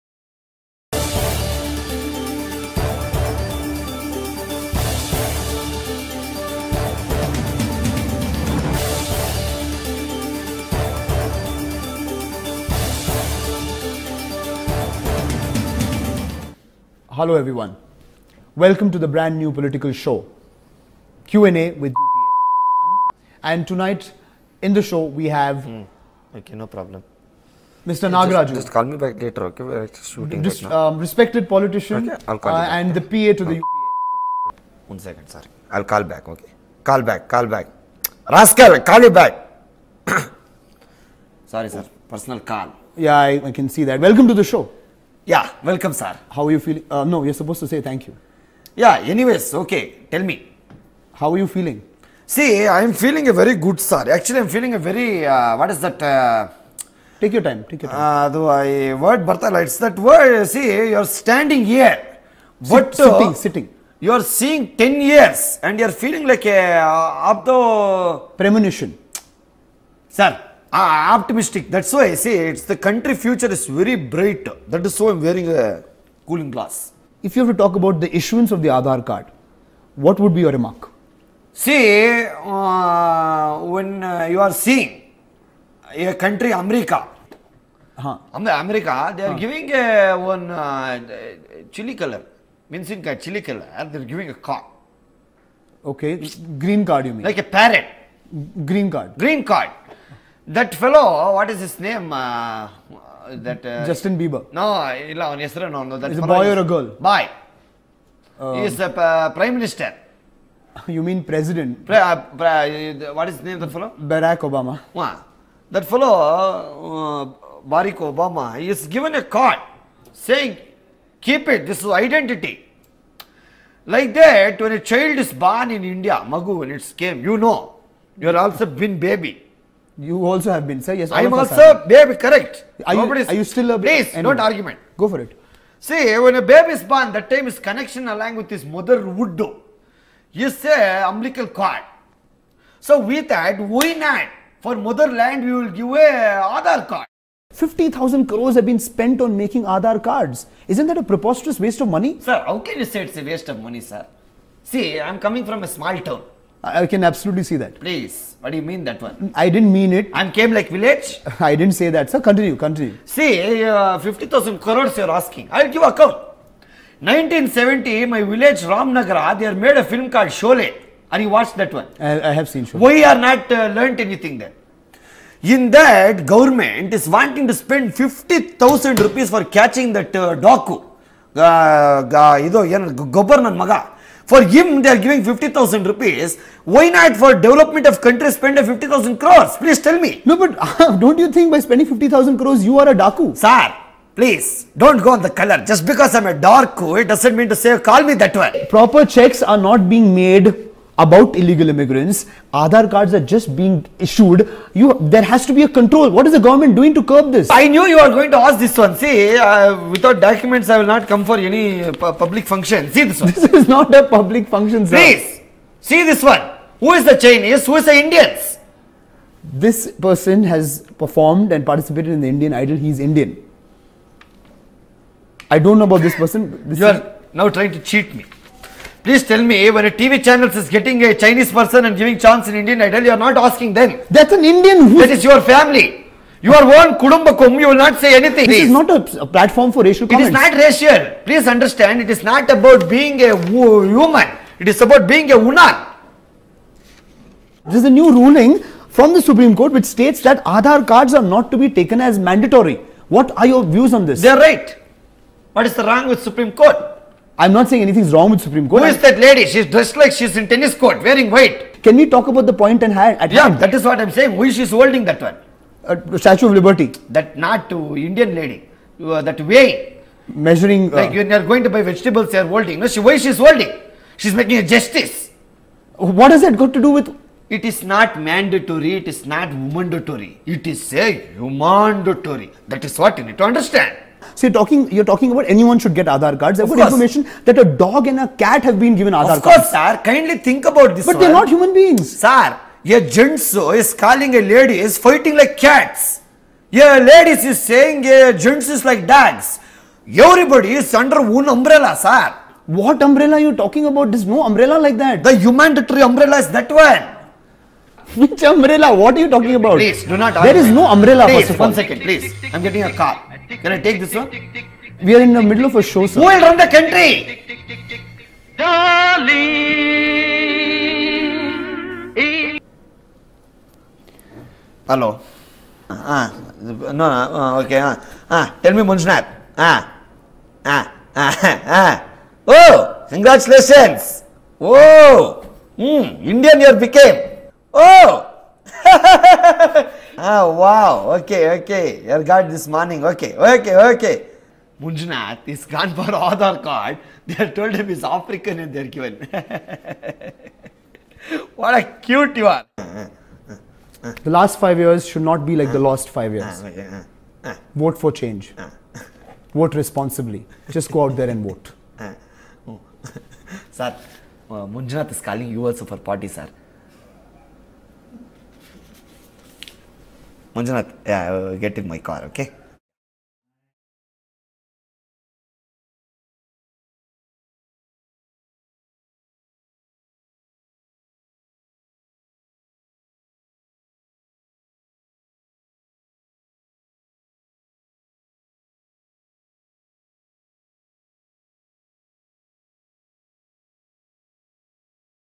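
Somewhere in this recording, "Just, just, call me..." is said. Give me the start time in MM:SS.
00:28.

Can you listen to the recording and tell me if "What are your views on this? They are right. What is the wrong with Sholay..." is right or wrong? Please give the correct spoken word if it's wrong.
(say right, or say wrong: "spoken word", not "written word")
wrong: "Supreme", not "Sholay".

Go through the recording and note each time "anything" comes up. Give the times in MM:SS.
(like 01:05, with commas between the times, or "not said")
02:53, 03:58, 04:17.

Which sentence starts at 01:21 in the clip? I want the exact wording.
See, uh, when uh, you are seeing a country, America, huh.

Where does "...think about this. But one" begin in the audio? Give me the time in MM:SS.
04:50.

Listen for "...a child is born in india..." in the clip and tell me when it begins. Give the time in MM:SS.
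02:04.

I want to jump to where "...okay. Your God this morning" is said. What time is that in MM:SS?
05:41.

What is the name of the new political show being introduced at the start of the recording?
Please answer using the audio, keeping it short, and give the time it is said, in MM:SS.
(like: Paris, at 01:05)
Q&A with UPA, at 00:21.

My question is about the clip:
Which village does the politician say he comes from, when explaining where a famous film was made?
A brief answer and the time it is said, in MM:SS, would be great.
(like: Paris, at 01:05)
Ramnagara, at 02:48.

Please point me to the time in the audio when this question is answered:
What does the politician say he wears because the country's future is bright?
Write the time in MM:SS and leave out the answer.
01:16.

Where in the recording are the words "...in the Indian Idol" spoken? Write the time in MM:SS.
03:42.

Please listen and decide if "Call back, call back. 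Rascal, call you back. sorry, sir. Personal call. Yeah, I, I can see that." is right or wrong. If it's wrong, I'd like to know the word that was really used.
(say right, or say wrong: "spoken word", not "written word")
right.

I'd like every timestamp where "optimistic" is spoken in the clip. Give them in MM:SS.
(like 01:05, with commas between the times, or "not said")
01:11.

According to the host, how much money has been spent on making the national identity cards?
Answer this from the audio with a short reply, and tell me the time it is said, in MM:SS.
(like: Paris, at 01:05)
50,000 crores, at 02:27.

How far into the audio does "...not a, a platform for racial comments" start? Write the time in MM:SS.
03:58.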